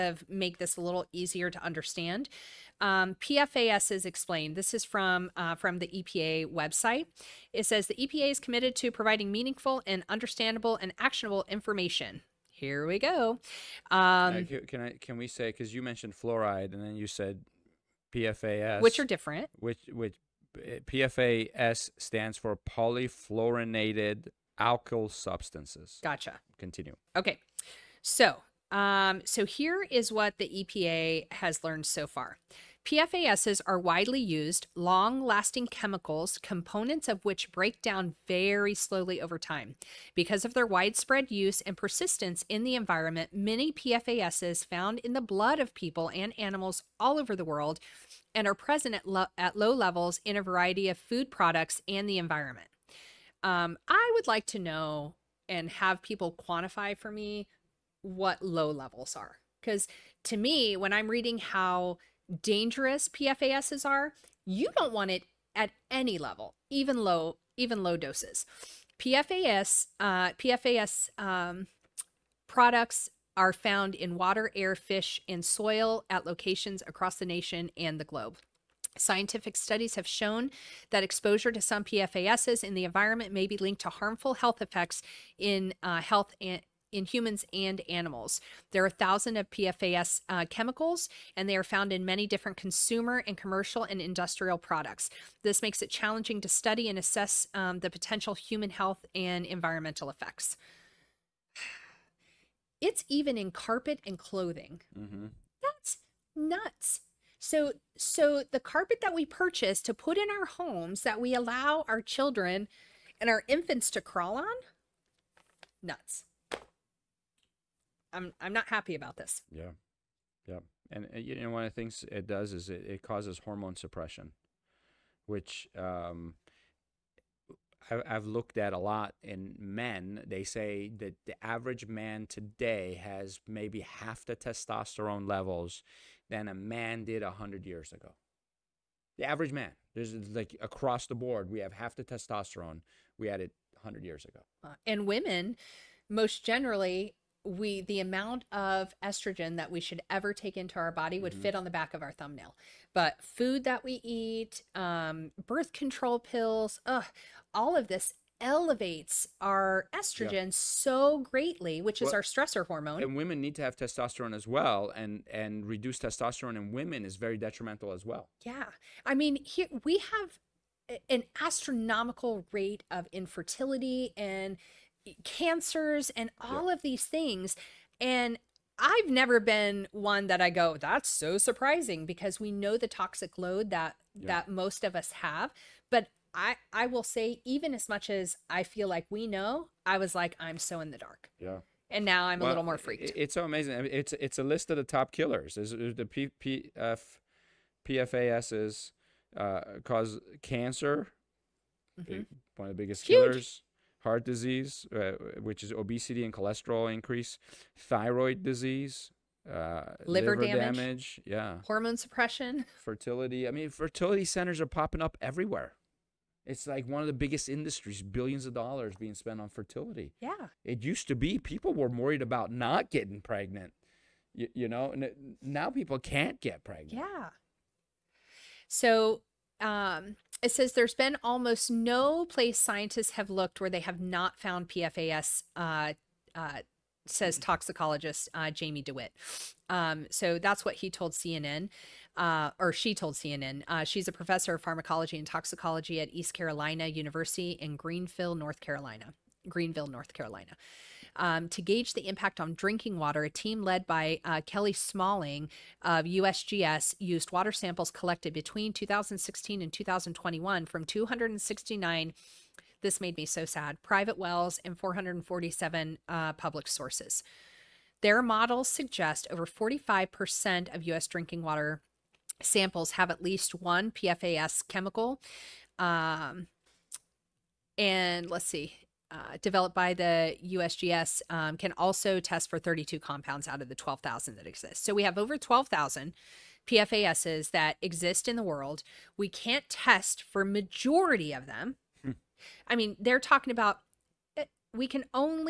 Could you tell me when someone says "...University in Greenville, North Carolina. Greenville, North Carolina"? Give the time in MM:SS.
04:06.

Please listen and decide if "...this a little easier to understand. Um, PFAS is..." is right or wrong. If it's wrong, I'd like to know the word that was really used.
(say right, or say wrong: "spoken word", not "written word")
right.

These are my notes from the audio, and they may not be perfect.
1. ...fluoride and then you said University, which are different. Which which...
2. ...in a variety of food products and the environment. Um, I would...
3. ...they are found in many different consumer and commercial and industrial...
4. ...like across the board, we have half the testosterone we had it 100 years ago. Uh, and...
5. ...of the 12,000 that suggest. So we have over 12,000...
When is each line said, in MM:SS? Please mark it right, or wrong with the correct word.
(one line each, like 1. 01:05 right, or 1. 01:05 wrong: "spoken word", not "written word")
1. 00:16 wrong: "PFAS", not "University"
2. 00:50 right
3. 01:31 right
4. 02:20 right
5. 04:43 wrong: "exist", not "suggest".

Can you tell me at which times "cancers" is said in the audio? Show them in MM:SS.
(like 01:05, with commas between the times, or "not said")
02:55, 03:20.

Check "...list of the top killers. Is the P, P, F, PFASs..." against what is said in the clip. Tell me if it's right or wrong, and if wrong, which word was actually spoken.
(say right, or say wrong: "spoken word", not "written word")
right.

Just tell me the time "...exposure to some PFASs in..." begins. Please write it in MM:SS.
01:21.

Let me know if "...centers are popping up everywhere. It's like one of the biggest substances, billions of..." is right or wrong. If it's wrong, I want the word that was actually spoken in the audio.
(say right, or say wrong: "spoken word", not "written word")
wrong: "industries", not "substances".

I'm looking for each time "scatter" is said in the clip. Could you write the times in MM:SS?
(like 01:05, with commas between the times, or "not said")
not said.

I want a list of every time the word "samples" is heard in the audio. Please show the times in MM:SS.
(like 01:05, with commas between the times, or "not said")
04:17, 04:32.